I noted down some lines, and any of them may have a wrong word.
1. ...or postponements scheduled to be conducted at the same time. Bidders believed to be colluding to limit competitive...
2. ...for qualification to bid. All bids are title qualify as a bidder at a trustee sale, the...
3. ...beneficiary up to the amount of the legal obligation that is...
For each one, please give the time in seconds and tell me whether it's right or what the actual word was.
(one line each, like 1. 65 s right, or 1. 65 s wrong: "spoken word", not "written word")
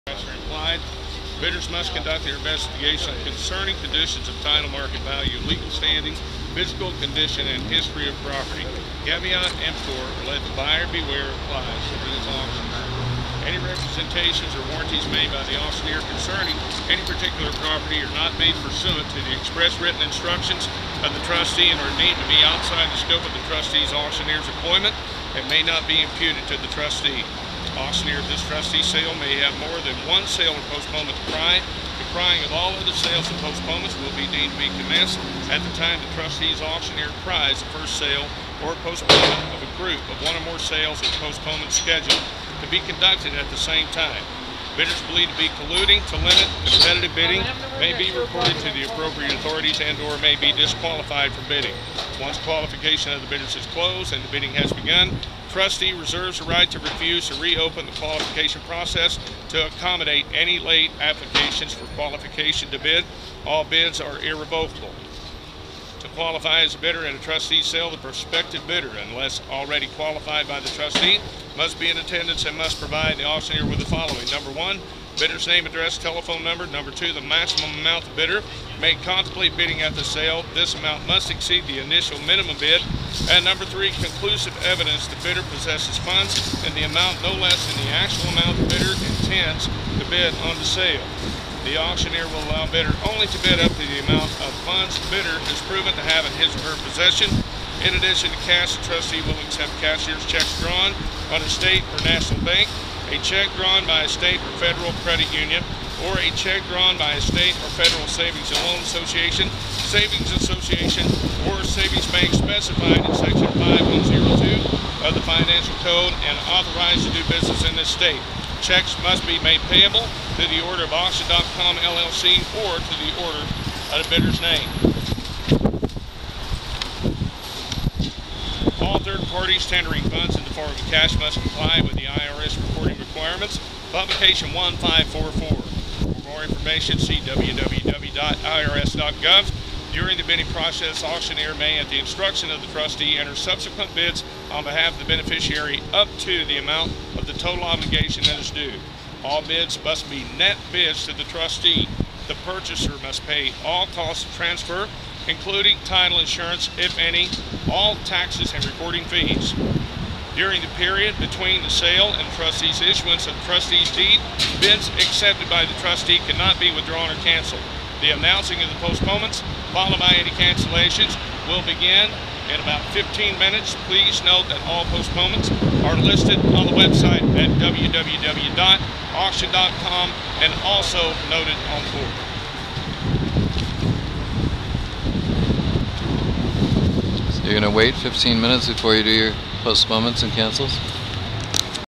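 1. 41 s right
2. 61 s wrong: "irrevocable", not "title"
3. 145 s wrong: "total", not "legal".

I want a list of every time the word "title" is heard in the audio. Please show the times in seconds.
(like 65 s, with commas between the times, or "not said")
4 s, 155 s.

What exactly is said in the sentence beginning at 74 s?
Number one, bidder's name, address, telephone number.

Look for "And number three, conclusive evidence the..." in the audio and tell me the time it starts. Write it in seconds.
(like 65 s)
83 s.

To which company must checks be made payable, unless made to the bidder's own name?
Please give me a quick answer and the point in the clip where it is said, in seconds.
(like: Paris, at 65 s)
Auction.com LLC, at 120 s.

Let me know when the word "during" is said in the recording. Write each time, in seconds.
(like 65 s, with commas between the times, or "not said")
139 s, 160 s.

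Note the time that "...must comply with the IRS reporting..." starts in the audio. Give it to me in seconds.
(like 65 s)
131 s.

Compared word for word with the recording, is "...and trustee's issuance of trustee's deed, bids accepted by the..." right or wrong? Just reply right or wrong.
right.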